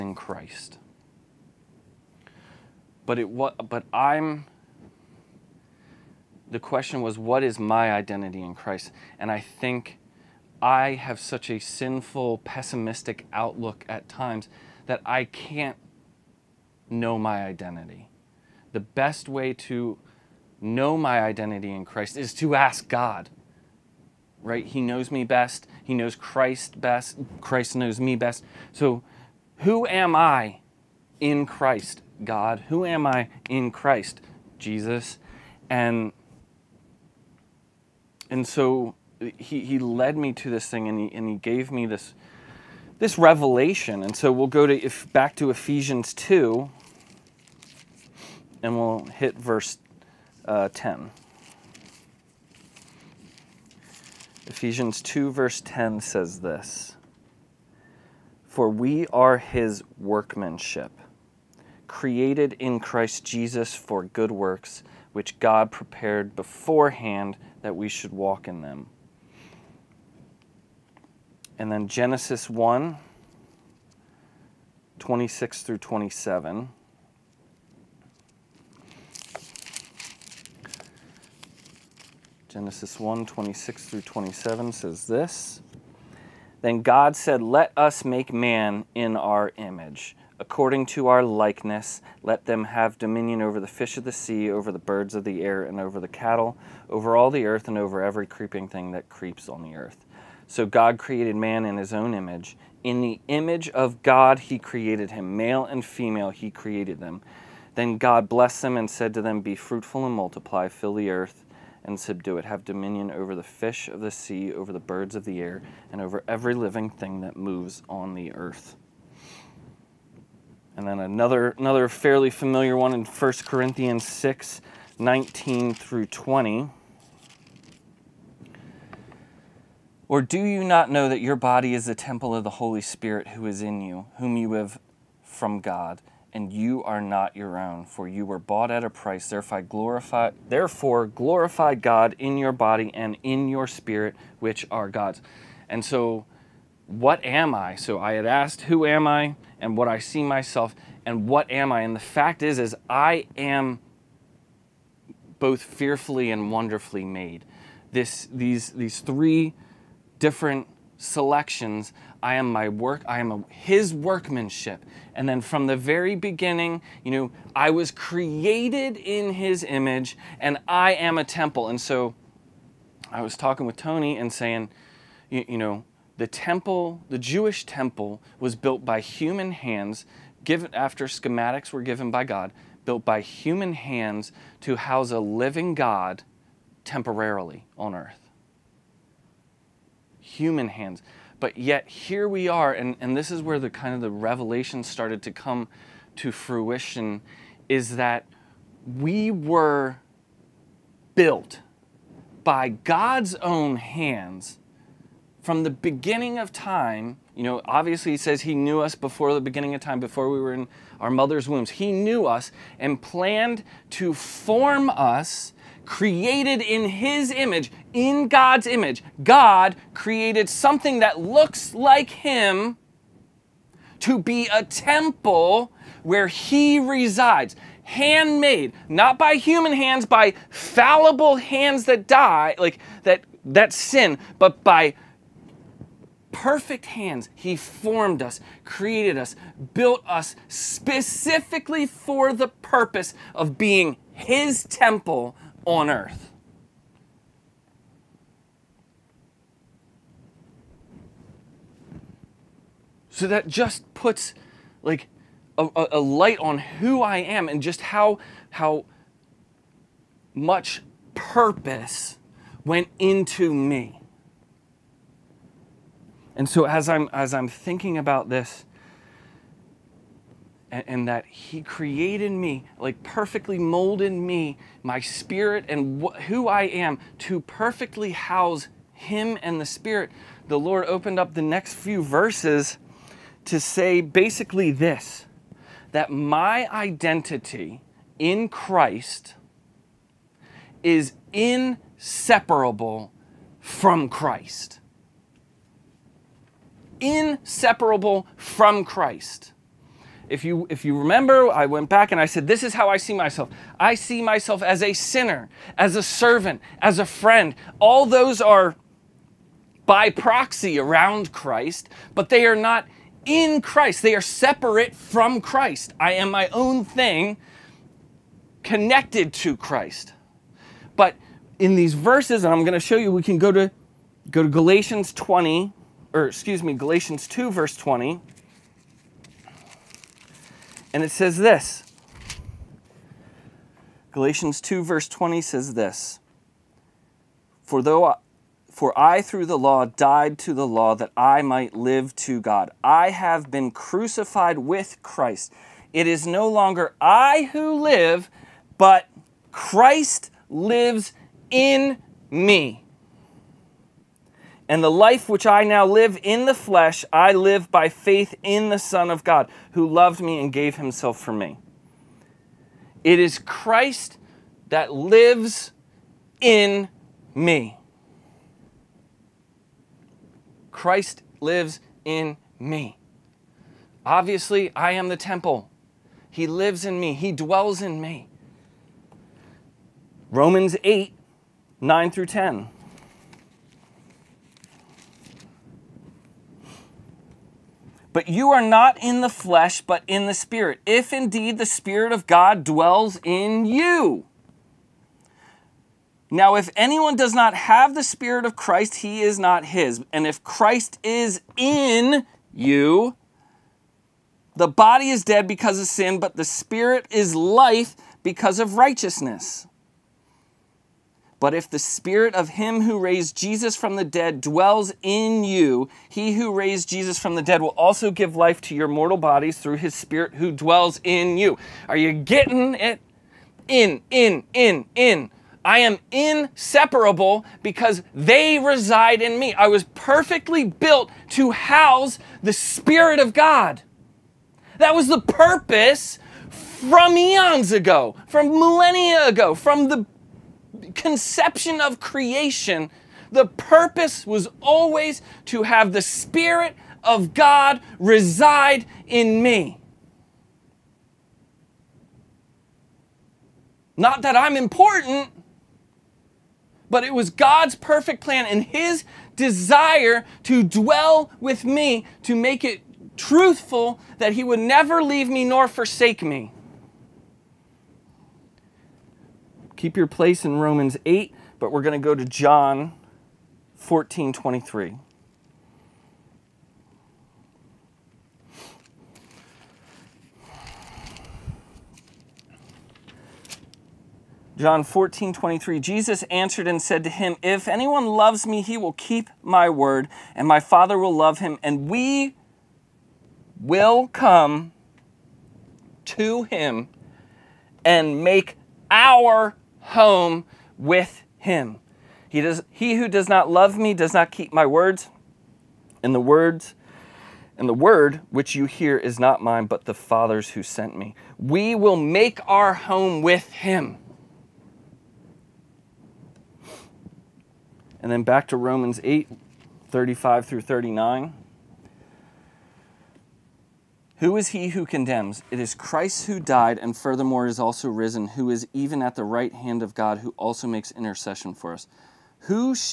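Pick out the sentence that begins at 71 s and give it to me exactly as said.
And then Genesis 1 26 through 27.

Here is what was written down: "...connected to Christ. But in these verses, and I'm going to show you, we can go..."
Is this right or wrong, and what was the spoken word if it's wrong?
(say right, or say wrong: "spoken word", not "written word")
right.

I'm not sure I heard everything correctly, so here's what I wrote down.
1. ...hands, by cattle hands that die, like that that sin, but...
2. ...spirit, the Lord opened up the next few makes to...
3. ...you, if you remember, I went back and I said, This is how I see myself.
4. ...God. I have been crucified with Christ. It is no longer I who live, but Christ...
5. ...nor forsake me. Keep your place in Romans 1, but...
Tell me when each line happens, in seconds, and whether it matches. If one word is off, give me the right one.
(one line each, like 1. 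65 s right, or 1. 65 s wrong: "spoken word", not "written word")
1. 229 s wrong: "fallible", not "cattle"
2. 279 s wrong: "verses", not "makes"
3. 300 s right
4. 342 s right
5. 465 s wrong: "8", not "1".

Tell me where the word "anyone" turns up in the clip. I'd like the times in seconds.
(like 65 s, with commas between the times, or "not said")
396 s, 487 s.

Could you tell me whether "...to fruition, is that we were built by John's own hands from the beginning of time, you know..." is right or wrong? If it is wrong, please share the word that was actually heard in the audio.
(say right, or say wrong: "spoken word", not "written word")
wrong: "God", not "John".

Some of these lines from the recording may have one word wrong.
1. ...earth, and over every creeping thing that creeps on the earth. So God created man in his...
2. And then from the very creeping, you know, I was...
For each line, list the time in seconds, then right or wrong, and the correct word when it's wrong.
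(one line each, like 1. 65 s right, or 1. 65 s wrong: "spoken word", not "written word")
1. 97 s right
2. 165 s wrong: "beginning", not "creeping".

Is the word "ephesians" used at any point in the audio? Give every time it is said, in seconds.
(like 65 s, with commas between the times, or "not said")
45 s, 54 s.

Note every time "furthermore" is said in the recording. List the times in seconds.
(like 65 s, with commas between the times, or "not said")
526 s.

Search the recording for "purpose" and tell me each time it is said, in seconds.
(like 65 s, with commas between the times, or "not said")
242 s, 261 s, 435 s, 443 s.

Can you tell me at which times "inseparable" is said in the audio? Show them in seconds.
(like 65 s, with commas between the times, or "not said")
291 s, 297 s, 426 s.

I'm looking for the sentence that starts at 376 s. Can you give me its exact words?
He lives in me, He dwells in me.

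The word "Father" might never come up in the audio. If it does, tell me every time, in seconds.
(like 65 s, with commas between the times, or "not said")
490 s, 509 s.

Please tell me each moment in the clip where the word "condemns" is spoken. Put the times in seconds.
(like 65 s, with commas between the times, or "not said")
524 s.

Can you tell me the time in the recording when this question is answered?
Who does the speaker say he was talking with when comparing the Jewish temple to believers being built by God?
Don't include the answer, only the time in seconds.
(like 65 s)
173 s.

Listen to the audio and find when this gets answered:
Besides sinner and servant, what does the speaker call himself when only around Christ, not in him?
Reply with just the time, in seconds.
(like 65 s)
306 s.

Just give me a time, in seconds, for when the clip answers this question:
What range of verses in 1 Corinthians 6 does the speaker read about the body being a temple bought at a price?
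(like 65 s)
124 s.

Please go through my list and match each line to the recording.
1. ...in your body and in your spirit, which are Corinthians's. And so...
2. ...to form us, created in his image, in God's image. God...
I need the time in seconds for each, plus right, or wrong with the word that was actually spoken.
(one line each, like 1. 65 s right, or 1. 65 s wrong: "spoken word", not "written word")
1. 142 s wrong: "God", not "Corinthians"
2. 213 s right.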